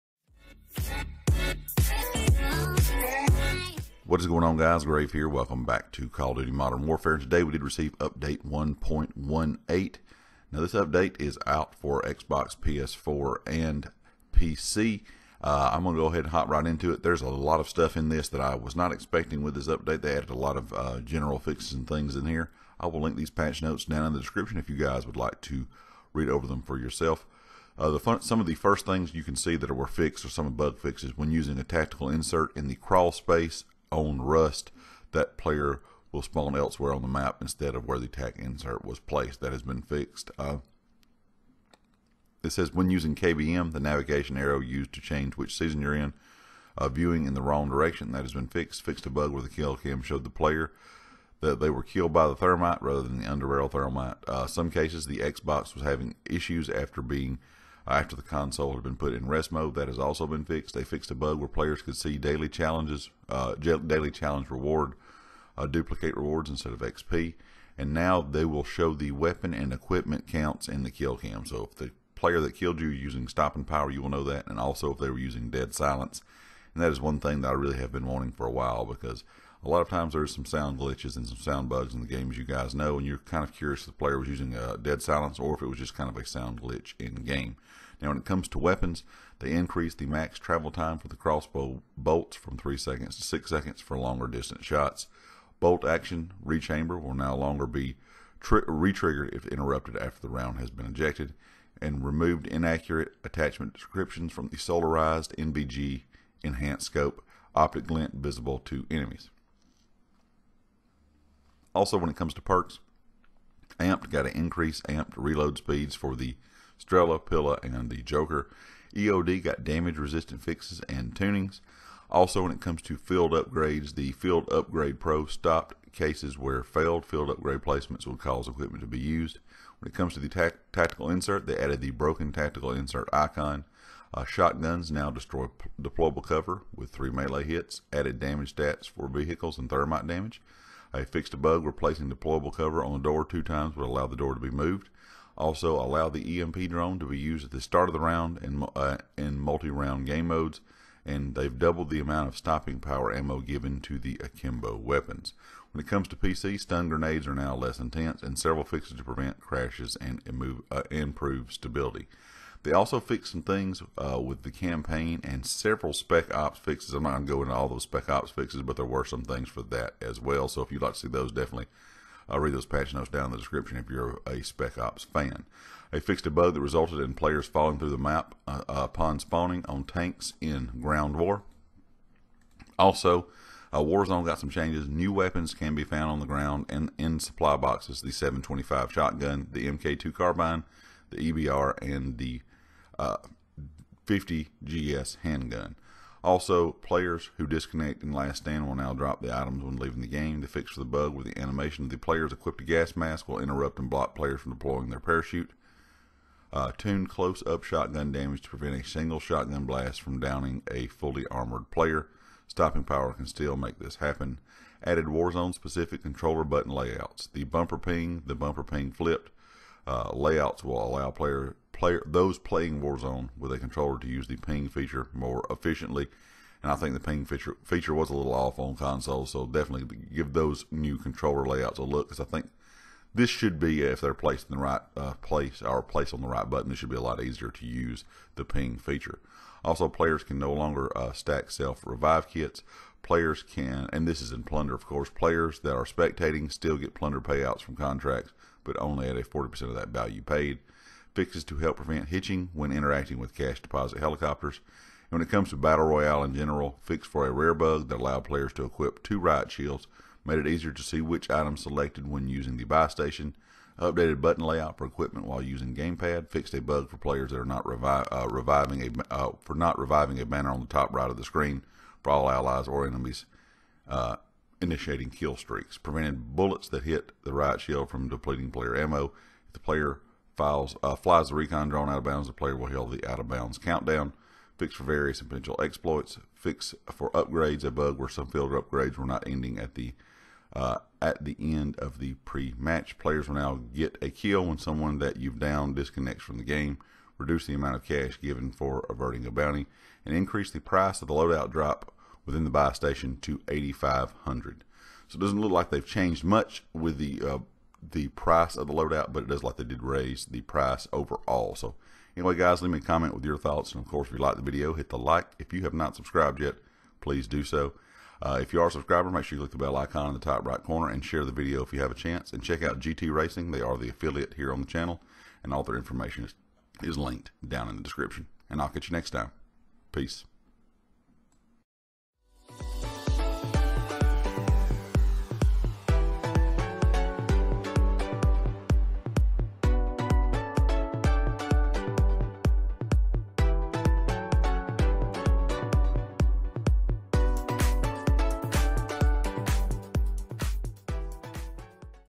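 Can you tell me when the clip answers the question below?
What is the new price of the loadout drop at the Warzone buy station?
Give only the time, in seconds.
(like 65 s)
303 s.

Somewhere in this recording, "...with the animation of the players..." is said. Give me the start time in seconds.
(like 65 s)
201 s.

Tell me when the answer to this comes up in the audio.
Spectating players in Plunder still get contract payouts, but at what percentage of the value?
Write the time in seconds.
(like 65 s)
249 s.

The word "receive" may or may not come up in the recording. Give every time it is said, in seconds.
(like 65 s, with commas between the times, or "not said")
7 s.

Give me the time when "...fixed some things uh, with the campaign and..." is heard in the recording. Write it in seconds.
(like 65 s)
162 s.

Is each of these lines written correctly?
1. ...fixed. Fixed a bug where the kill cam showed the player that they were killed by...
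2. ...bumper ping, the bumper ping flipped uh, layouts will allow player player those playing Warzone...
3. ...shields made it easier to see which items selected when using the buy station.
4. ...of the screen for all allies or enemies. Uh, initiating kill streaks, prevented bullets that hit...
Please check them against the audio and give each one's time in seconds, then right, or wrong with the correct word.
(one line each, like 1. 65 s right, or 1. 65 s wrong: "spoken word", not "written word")
1. 48 s right
2. 217 s right
3. 259 s right
4. 271 s right.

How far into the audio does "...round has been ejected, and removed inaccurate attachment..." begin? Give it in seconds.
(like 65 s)
100 s.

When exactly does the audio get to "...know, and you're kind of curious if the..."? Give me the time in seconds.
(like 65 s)
82 s.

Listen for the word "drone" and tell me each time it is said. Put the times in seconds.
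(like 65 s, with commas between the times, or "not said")
146 s, 281 s.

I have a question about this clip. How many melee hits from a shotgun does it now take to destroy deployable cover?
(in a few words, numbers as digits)
3.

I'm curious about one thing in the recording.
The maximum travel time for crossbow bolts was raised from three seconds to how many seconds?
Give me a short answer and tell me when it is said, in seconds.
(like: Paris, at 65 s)
6 seconds, at 93 s.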